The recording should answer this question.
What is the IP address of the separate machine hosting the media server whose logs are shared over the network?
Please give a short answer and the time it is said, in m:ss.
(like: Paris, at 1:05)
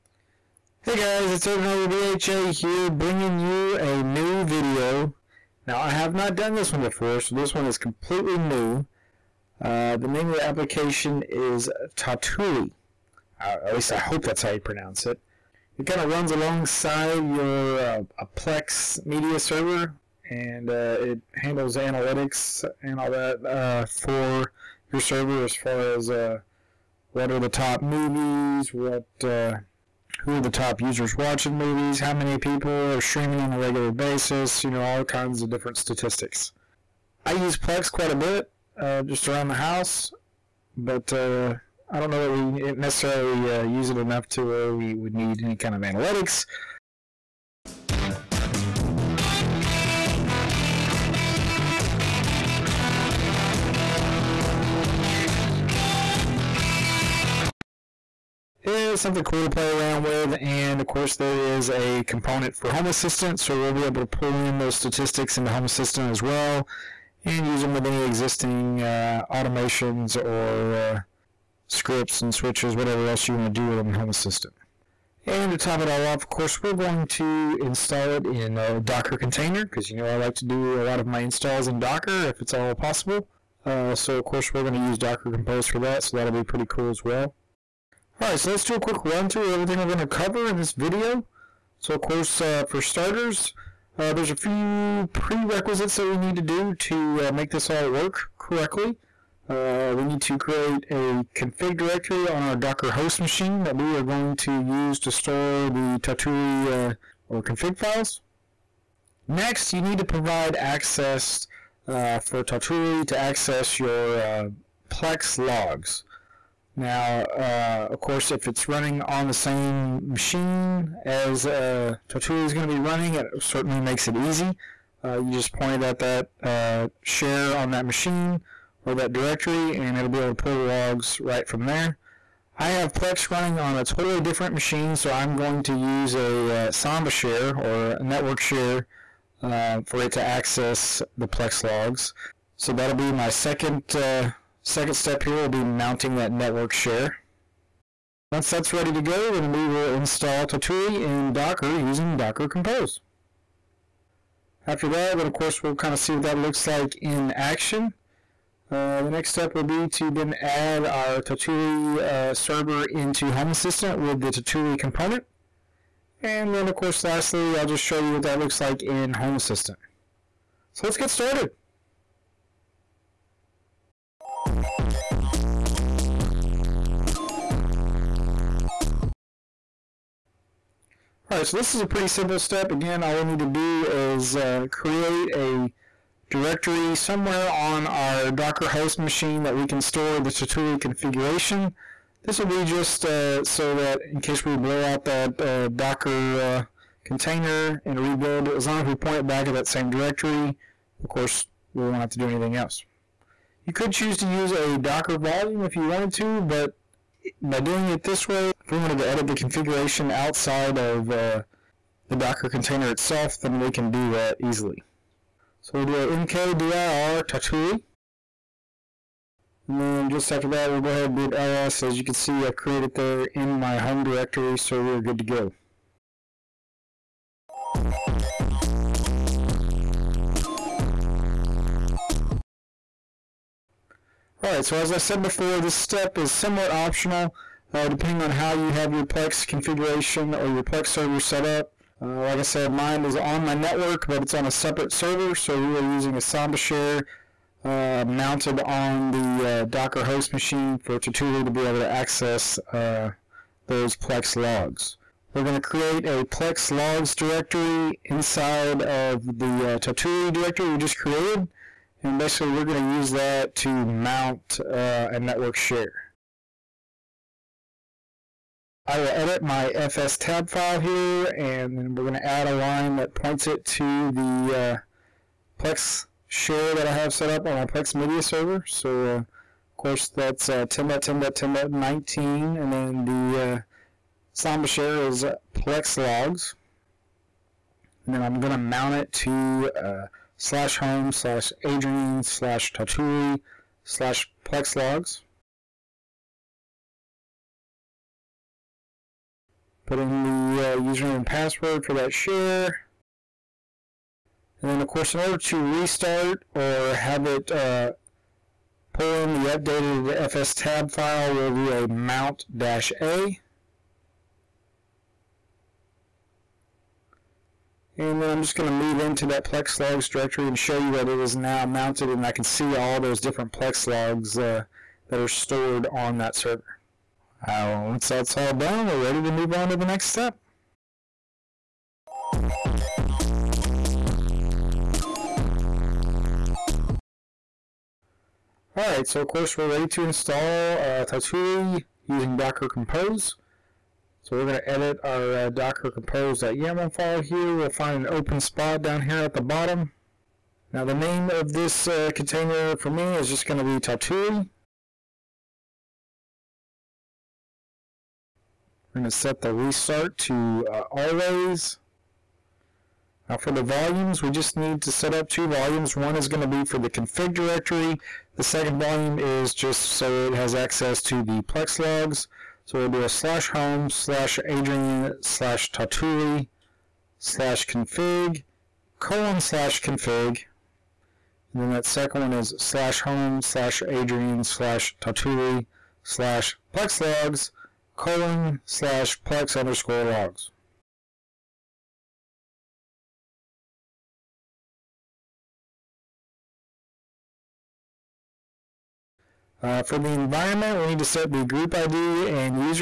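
10.10.10.19, at 4:40.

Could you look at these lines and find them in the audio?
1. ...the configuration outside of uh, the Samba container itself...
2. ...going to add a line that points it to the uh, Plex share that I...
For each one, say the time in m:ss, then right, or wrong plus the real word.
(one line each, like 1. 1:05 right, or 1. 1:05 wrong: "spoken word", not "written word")
1. 3:29 wrong: "Docker", not "Samba"
2. 4:32 right.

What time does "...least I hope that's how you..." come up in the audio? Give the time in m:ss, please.
0:13.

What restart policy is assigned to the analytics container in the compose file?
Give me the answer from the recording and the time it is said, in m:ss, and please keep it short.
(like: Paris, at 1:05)
always, at 6:00.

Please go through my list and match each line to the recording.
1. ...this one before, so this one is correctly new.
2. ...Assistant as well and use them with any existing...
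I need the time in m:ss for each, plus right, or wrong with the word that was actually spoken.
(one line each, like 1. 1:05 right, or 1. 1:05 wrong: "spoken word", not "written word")
1. 0:06 wrong: "completely", not "correctly"
2. 1:05 right.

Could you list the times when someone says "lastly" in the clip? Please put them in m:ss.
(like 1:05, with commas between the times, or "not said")
2:47.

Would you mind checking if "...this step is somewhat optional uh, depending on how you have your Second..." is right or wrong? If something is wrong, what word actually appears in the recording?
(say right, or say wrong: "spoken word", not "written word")
wrong: "Plex", not "Second".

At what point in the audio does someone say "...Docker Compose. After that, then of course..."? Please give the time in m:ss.
2:32.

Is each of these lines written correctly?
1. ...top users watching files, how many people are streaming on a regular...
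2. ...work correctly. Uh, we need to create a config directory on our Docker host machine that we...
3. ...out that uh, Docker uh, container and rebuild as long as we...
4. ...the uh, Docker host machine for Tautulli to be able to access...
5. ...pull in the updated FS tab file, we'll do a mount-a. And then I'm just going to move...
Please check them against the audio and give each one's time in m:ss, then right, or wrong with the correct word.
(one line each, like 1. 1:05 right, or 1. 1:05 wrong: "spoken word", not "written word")
1. 0:30 wrong: "movies", not "files"
2. 1:37 right
3. 3:14 right
4. 4:09 right
5. 5:08 right.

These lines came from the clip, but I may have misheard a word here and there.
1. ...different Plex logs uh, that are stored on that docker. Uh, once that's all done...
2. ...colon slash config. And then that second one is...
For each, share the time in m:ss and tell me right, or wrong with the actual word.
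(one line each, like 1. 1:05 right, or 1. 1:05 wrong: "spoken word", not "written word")
1. 5:23 wrong: "server", not "docker"
2. 6:18 right.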